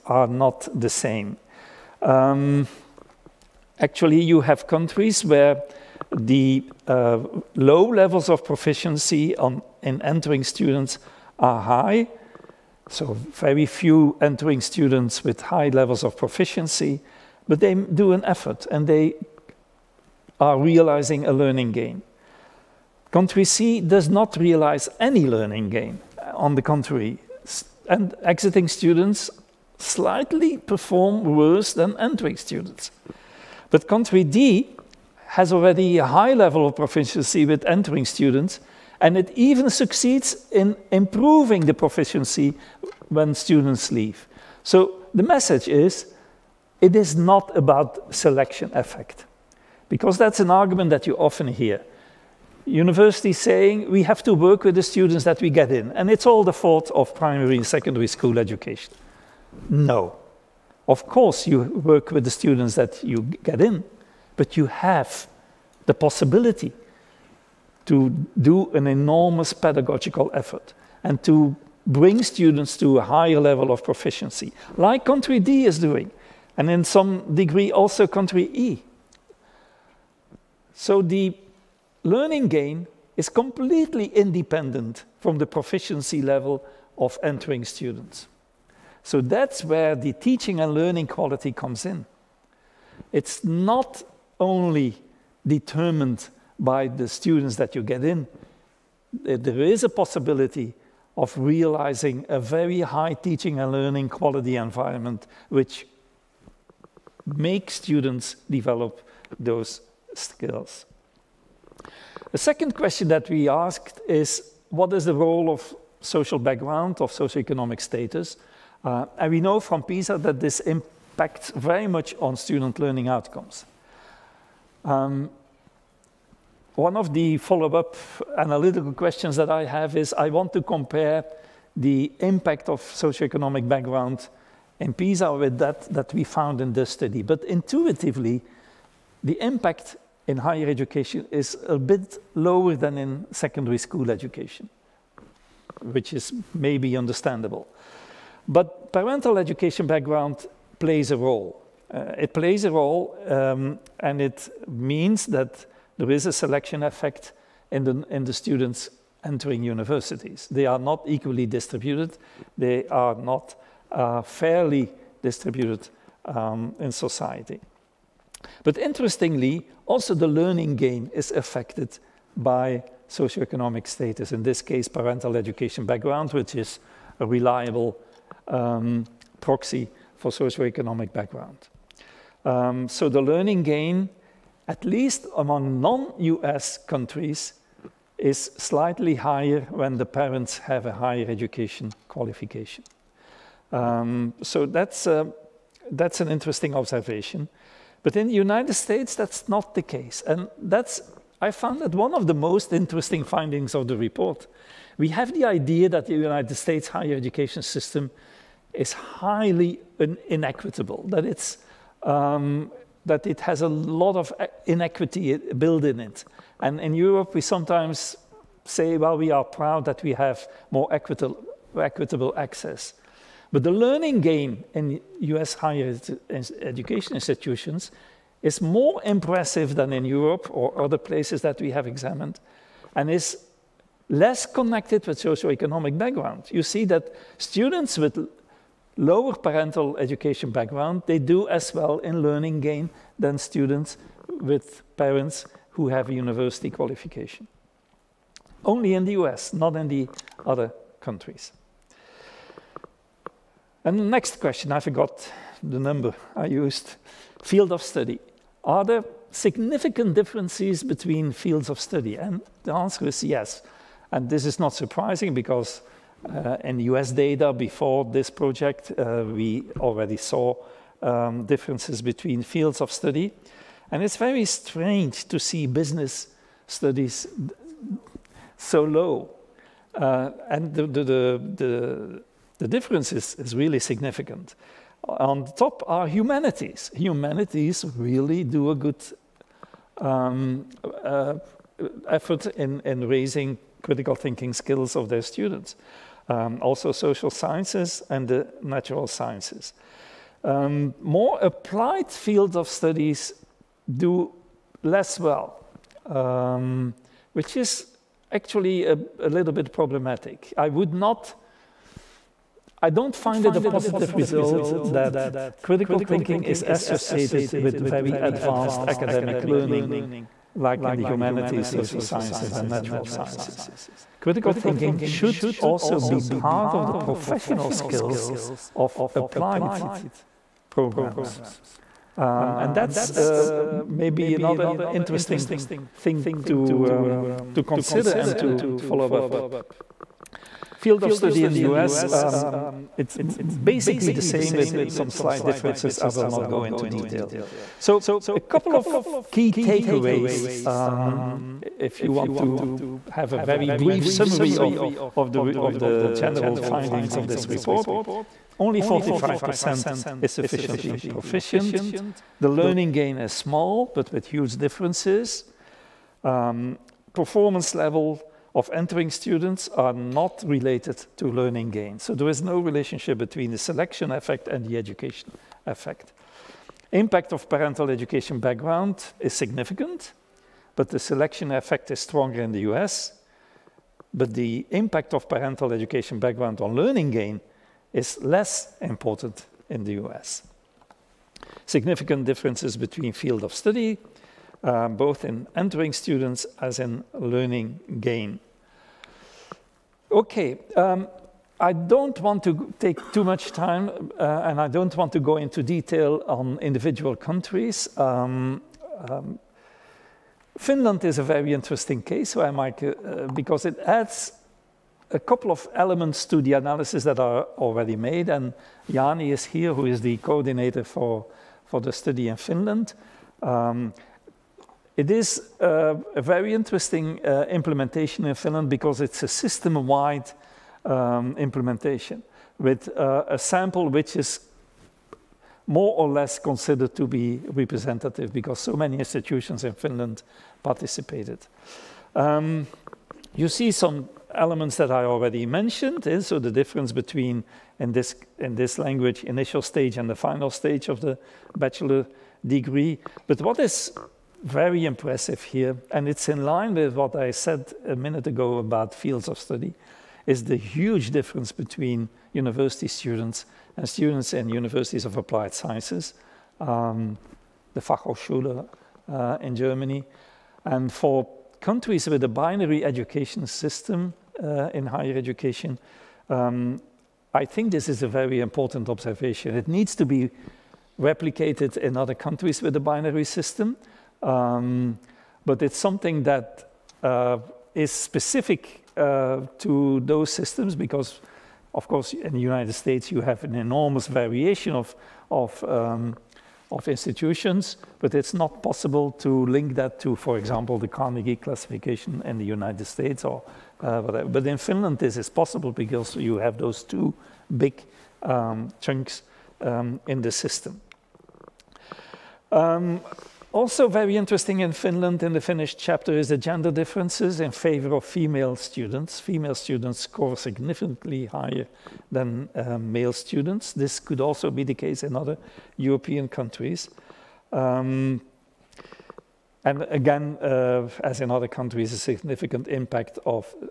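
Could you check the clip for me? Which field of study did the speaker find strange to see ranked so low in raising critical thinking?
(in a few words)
Business studies.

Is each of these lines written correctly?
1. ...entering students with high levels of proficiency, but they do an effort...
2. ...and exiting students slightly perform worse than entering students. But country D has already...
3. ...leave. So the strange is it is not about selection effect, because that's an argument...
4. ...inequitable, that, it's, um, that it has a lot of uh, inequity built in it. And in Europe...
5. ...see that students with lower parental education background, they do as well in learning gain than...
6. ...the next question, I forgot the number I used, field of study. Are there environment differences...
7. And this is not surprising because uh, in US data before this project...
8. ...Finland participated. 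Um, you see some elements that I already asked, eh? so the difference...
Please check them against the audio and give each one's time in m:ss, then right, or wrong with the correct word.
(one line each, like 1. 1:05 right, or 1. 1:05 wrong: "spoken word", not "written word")
1. 0:14 right
2. 0:27 right
3. 0:43 wrong: "message", not "strange"
4. 3:30 right
5. 3:56 right
6. 4:13 wrong: "significant", not "environment"
7. 4:24 right
8. 7:19 wrong: "mentioned", not "asked".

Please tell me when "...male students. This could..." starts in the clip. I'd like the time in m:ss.
8:42.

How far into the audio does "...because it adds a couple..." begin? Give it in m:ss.
6:53.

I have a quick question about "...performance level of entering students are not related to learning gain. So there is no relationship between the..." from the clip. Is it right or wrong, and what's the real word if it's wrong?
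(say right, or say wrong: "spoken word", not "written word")
right.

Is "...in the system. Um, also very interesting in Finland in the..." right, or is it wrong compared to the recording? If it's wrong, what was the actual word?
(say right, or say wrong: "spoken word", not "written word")
right.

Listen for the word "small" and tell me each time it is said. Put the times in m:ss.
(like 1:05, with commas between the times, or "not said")
6:03.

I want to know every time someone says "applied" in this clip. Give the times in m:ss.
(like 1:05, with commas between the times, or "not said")
5:01, 5:29, 7:45.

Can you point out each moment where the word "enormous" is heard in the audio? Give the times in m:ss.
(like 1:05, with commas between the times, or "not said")
1:08, 8:13.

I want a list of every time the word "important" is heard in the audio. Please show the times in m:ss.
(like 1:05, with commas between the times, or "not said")
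6:28, 7:58.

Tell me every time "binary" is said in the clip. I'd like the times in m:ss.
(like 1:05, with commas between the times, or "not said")
7:52, 8:02.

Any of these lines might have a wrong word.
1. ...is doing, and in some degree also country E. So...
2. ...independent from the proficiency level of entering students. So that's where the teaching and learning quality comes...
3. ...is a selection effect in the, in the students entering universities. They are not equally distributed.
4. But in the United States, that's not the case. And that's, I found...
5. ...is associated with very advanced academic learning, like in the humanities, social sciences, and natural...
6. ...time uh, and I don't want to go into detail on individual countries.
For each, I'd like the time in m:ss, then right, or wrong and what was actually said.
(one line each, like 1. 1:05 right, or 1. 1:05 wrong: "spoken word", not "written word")
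1. 1:15 right
2. 1:24 right
3. 2:36 right
4. 3:18 right
5. 5:16 right
6. 6:43 right.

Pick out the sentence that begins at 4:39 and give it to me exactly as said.
Uh, and the, the, the, the the difference is, is really significant.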